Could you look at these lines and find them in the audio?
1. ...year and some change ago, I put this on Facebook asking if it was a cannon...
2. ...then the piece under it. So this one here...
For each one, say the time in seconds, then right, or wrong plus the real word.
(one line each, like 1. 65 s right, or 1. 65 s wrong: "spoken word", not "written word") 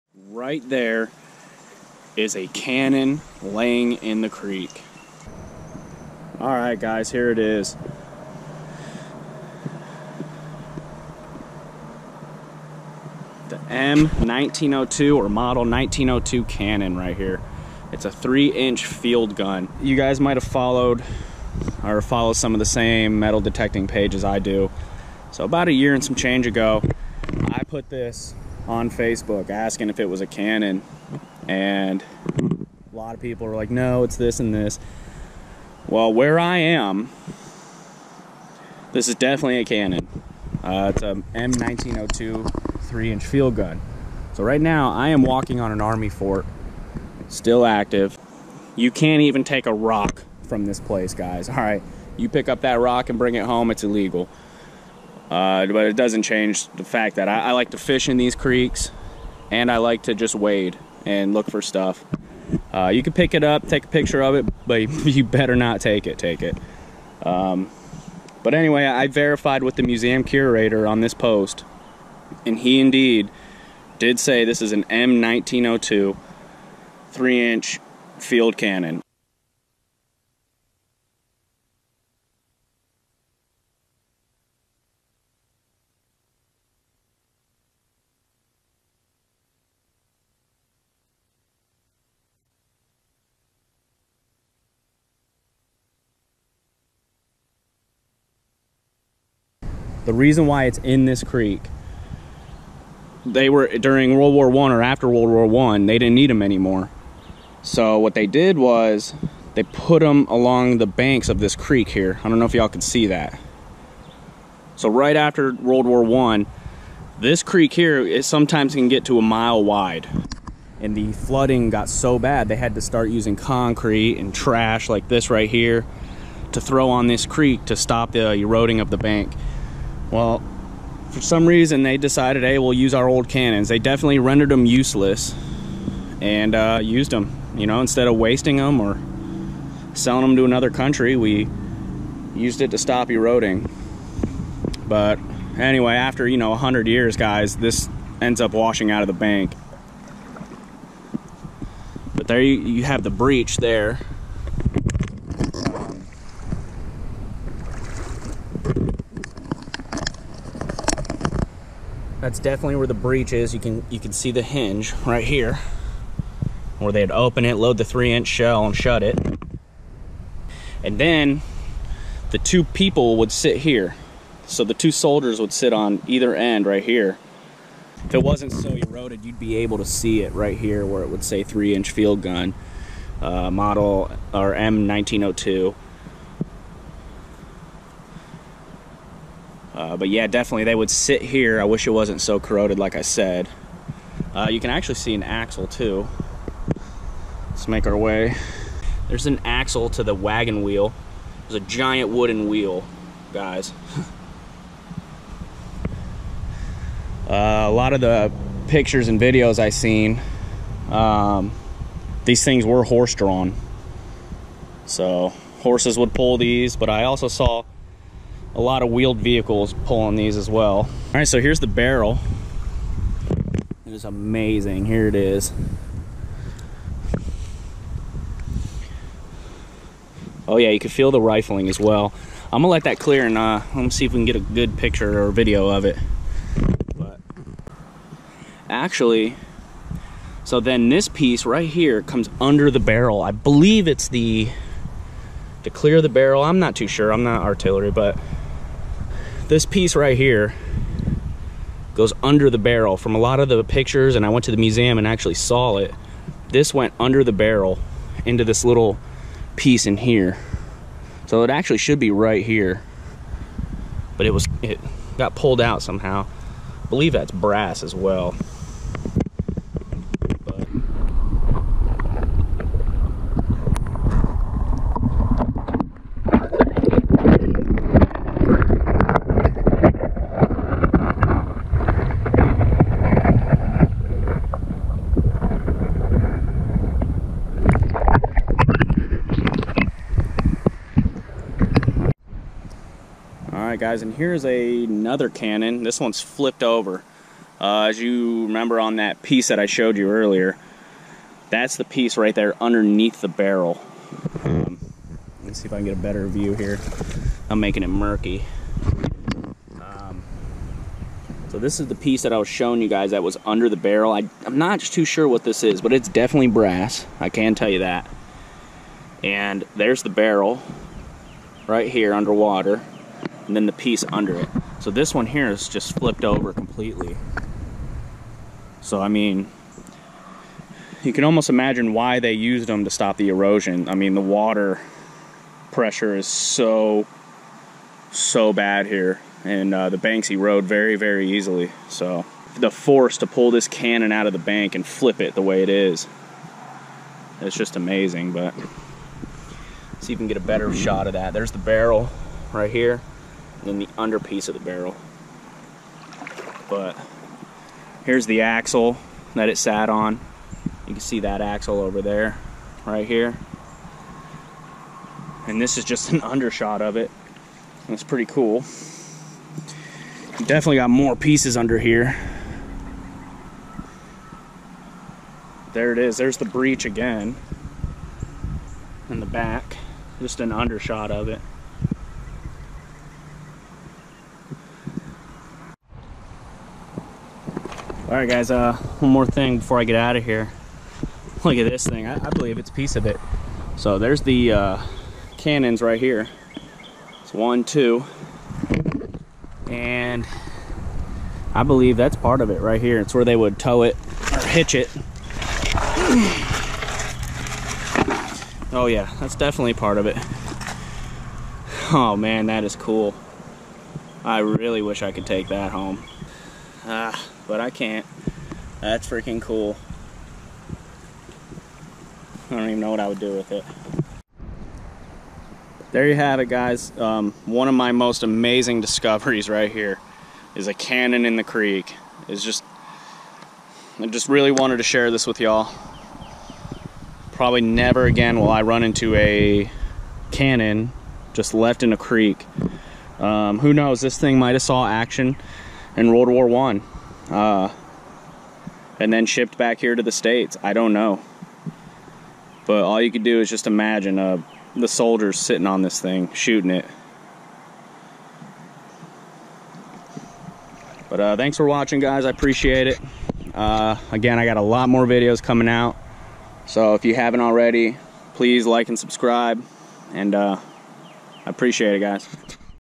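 1. 25 s right
2. 323 s right.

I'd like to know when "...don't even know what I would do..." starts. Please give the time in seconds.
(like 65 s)
422 s.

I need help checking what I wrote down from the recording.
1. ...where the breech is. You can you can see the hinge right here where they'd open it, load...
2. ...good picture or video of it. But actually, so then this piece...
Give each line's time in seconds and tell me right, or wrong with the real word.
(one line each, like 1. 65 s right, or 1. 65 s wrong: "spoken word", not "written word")
1. 162 s right
2. 234 s right.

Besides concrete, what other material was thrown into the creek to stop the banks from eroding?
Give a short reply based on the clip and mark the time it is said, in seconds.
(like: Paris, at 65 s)
Trash, at 124 s.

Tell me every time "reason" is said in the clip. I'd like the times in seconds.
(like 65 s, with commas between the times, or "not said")
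100 s, 131 s.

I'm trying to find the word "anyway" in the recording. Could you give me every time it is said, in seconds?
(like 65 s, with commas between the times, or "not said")
68 s, 145 s.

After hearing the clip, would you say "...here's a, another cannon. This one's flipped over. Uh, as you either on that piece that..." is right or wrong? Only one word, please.
wrong.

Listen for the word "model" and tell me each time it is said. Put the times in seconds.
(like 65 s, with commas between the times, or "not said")
15 s, 183 s.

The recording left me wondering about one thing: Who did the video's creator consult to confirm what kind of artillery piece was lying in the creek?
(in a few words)
The museum curator.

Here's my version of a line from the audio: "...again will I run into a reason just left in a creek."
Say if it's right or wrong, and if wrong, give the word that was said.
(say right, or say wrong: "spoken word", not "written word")
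wrong: "cannon", not "reason".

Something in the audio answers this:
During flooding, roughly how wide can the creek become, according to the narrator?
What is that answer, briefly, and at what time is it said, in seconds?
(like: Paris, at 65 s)
A mile wide, at 119 s.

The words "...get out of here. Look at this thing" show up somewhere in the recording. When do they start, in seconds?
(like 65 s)
389 s.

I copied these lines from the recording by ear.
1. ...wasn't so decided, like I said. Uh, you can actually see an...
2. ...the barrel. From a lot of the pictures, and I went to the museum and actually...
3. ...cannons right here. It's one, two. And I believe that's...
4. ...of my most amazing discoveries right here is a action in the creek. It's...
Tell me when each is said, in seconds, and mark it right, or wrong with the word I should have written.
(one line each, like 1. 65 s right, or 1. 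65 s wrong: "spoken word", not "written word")
1. 191 s wrong: "corroded", not "decided"
2. 252 s right
3. 395 s right
4. 427 s wrong: "cannon", not "action".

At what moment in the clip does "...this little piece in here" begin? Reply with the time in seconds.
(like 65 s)
258 s.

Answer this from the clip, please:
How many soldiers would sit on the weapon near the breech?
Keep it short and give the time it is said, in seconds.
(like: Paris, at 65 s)
2, at 174 s.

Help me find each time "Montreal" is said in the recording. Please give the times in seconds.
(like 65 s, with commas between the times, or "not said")
not said.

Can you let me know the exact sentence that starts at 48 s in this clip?
You can't even take a rock from this place, guys.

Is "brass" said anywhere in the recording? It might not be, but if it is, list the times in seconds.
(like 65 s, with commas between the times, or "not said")
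267 s, 316 s.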